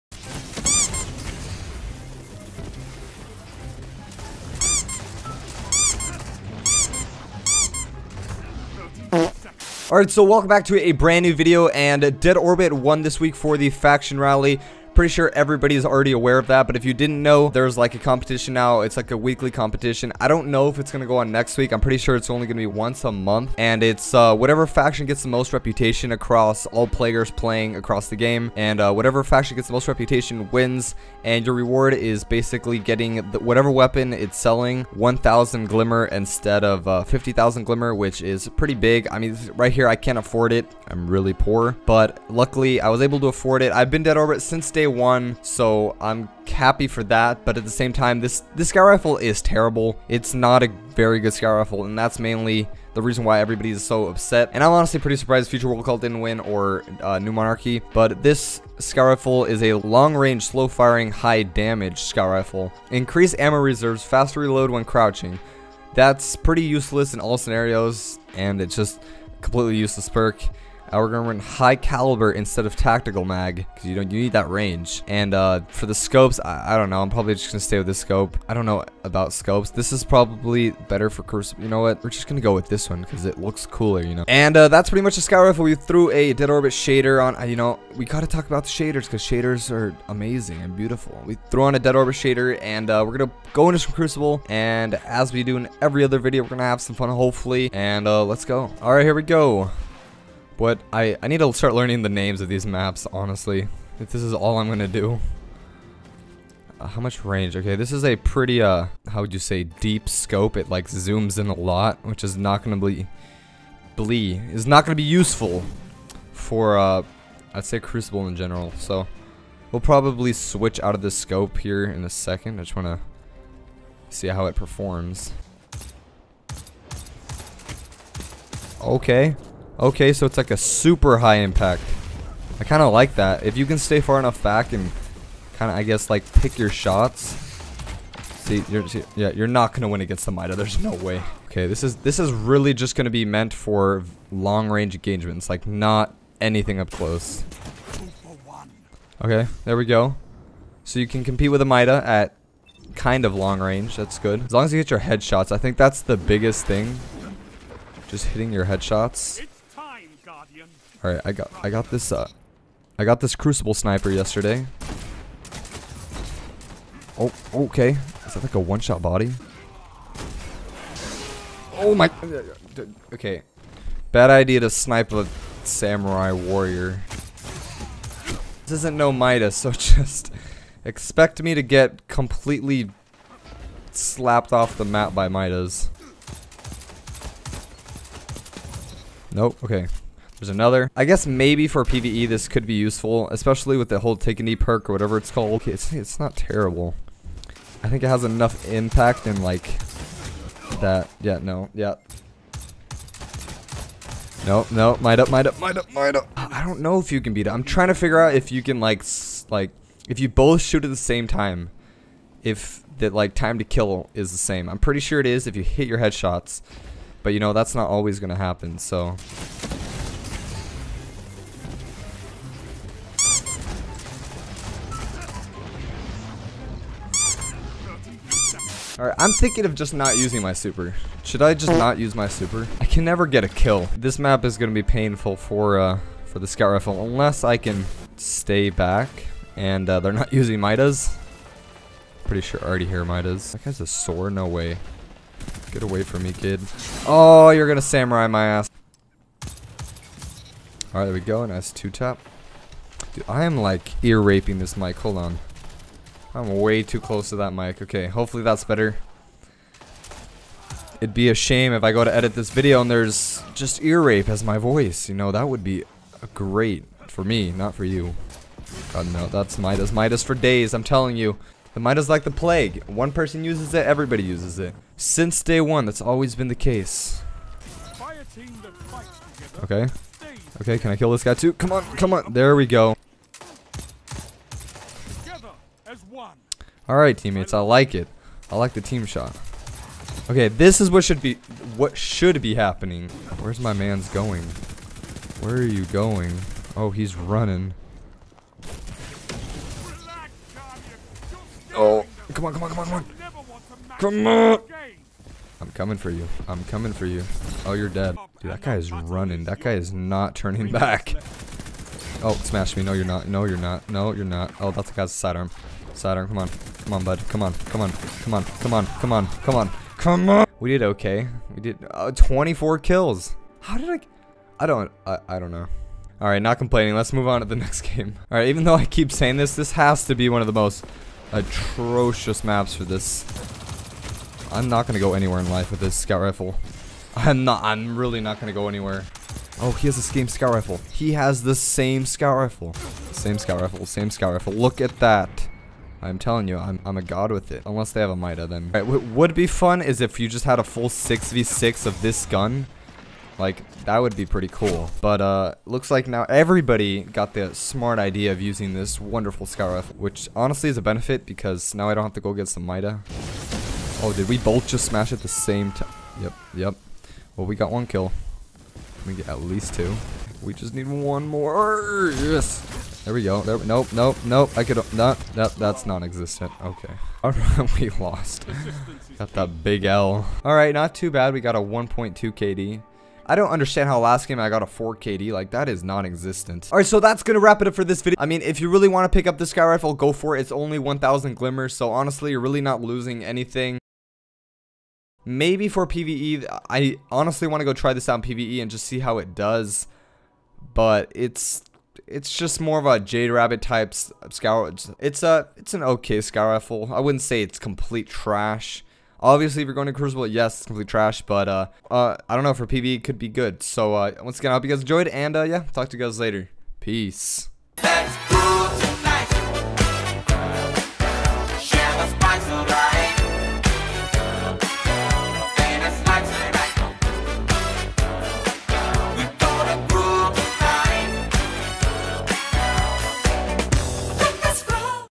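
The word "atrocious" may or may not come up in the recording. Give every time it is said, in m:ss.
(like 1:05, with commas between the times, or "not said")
5:31.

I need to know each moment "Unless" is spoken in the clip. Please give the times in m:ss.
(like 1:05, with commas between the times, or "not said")
3:57, 5:47.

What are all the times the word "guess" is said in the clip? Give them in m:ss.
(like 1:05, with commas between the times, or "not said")
2:15, 3:11.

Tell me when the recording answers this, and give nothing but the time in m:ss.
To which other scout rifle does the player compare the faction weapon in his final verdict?
6:42.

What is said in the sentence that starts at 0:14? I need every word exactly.
Pretty sure everybody's already aware of that, but if you didn't know, there's like a competition now.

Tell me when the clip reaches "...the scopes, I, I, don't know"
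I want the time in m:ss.
1:15.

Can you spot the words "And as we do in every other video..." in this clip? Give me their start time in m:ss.
1:34.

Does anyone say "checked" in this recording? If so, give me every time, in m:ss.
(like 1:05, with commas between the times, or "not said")
not said.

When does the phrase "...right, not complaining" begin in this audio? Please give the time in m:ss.
5:26.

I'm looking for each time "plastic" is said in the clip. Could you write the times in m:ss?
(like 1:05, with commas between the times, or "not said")
not said.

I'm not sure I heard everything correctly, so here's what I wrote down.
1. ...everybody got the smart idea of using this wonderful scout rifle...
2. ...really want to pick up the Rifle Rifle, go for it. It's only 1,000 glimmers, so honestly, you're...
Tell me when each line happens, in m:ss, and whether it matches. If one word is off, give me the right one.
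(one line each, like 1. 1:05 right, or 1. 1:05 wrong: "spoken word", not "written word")
1. 5:56 right
2. 6:28 wrong: "Scout", not "Rifle".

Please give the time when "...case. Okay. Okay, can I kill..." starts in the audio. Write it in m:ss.
4:36.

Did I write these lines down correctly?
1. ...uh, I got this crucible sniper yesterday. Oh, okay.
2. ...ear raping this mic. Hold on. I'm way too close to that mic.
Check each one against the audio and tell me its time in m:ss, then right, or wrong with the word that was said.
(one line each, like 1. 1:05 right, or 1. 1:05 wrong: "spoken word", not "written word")
1. 2:42 right
2. 4:14 right.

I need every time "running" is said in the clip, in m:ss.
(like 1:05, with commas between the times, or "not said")
4:57, 5:08.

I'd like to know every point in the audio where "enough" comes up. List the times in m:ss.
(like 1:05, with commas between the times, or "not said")
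2:14, 3:18.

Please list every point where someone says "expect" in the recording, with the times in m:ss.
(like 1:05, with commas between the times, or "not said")
3:00.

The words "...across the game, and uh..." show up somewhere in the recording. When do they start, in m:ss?
0:27.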